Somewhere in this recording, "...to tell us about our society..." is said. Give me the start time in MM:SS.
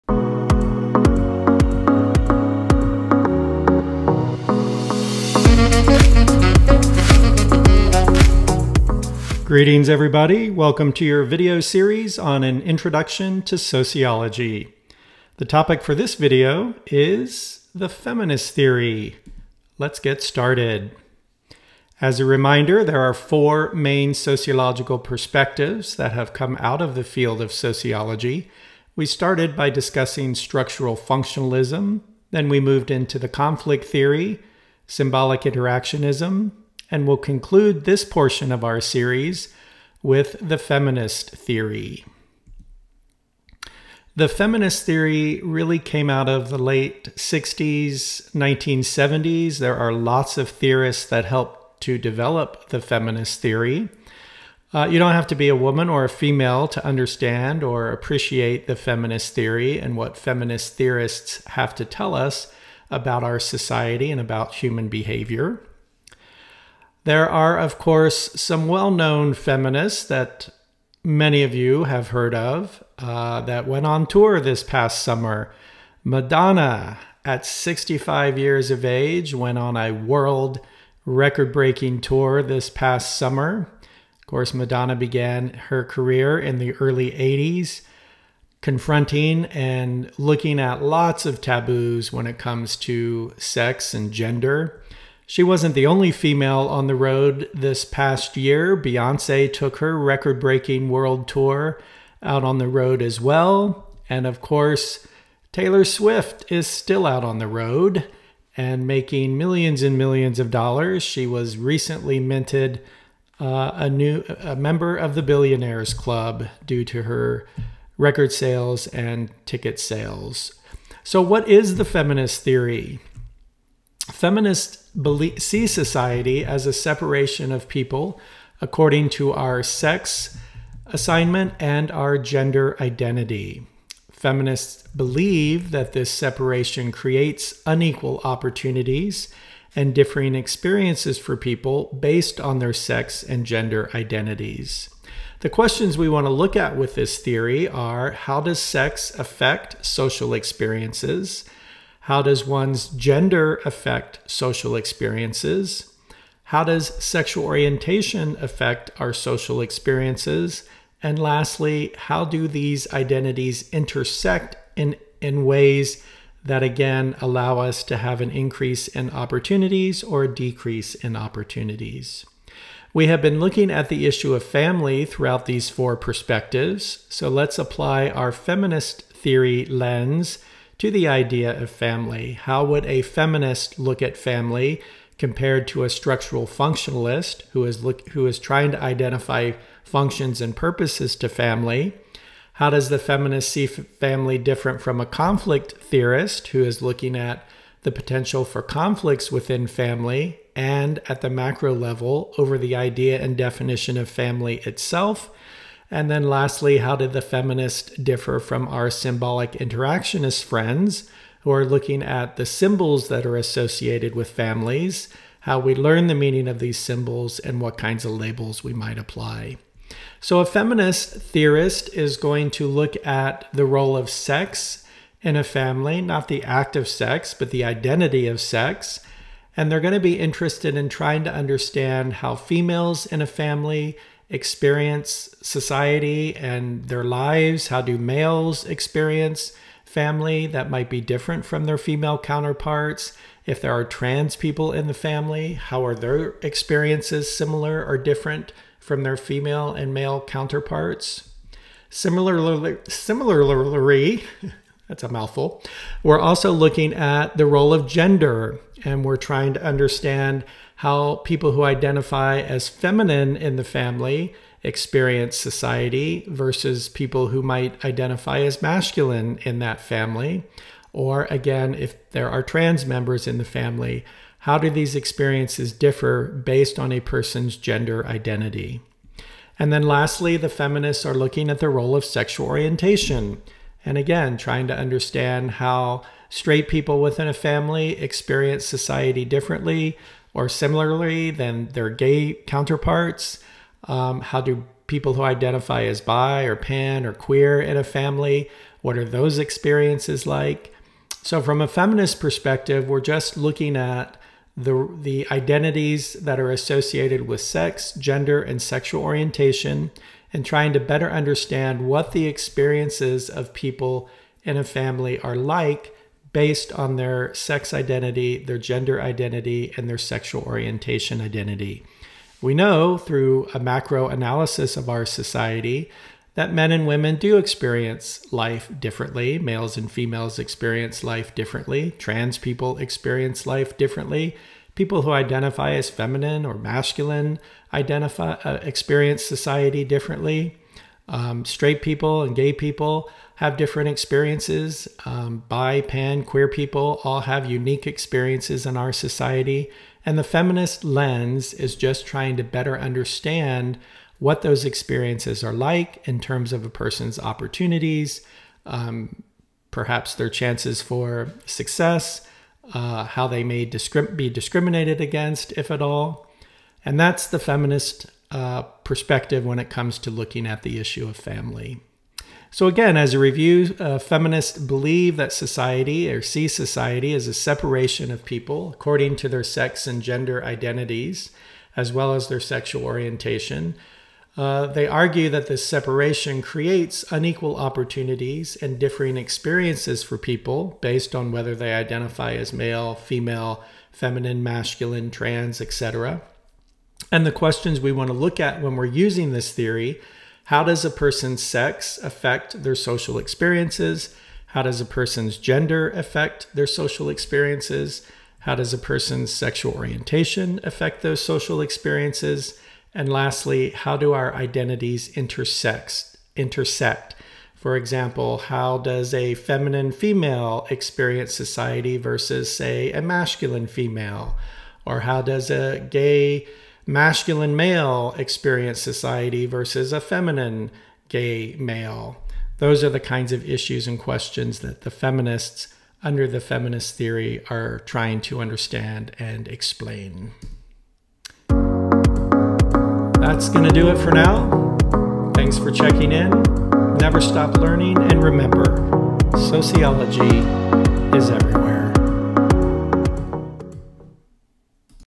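01:01.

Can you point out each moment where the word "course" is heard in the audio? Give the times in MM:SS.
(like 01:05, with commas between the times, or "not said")
01:07, 01:24, 01:44.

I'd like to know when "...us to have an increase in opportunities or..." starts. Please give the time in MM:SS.
02:47.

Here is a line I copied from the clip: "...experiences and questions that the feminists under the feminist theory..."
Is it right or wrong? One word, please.
wrong.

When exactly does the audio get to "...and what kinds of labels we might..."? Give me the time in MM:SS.
03:37.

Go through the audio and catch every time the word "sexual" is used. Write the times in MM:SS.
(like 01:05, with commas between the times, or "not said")
02:37, 04:42, 05:08, 05:19, 06:22, 06:49.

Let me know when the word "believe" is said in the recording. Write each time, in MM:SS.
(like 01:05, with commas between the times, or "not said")
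02:14, 06:14.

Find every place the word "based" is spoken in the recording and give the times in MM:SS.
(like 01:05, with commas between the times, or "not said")
02:22, 04:36, 05:16, 06:30.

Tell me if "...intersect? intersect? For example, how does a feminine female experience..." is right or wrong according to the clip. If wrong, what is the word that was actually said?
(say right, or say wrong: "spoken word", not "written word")
right.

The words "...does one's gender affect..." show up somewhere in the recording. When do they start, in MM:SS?
02:32.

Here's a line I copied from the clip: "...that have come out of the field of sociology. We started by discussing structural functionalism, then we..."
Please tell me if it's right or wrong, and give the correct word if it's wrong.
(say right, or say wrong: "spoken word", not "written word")
right.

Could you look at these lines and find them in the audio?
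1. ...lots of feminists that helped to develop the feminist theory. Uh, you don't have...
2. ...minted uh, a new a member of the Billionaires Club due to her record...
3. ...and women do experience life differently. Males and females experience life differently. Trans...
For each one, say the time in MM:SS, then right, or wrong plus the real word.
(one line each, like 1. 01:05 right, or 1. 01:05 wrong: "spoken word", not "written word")
1. 00:49 wrong: "theorists", not "feminists"
2. 01:52 right
3. 05:26 right.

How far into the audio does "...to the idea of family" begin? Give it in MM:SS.
03:00.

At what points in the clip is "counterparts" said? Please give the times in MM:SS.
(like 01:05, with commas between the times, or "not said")
04:02, 04:10, 04:52.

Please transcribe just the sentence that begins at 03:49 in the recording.
And they're going to be interested in trying to understand how females in a family experience society and their lives?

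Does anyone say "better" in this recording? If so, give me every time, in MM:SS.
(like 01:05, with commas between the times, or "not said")
05:10, 05:52.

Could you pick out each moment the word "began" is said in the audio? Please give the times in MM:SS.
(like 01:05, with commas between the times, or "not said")
01:24.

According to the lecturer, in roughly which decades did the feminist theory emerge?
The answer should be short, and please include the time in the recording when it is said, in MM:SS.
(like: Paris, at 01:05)
Late 60s, 1970s, at 00:46.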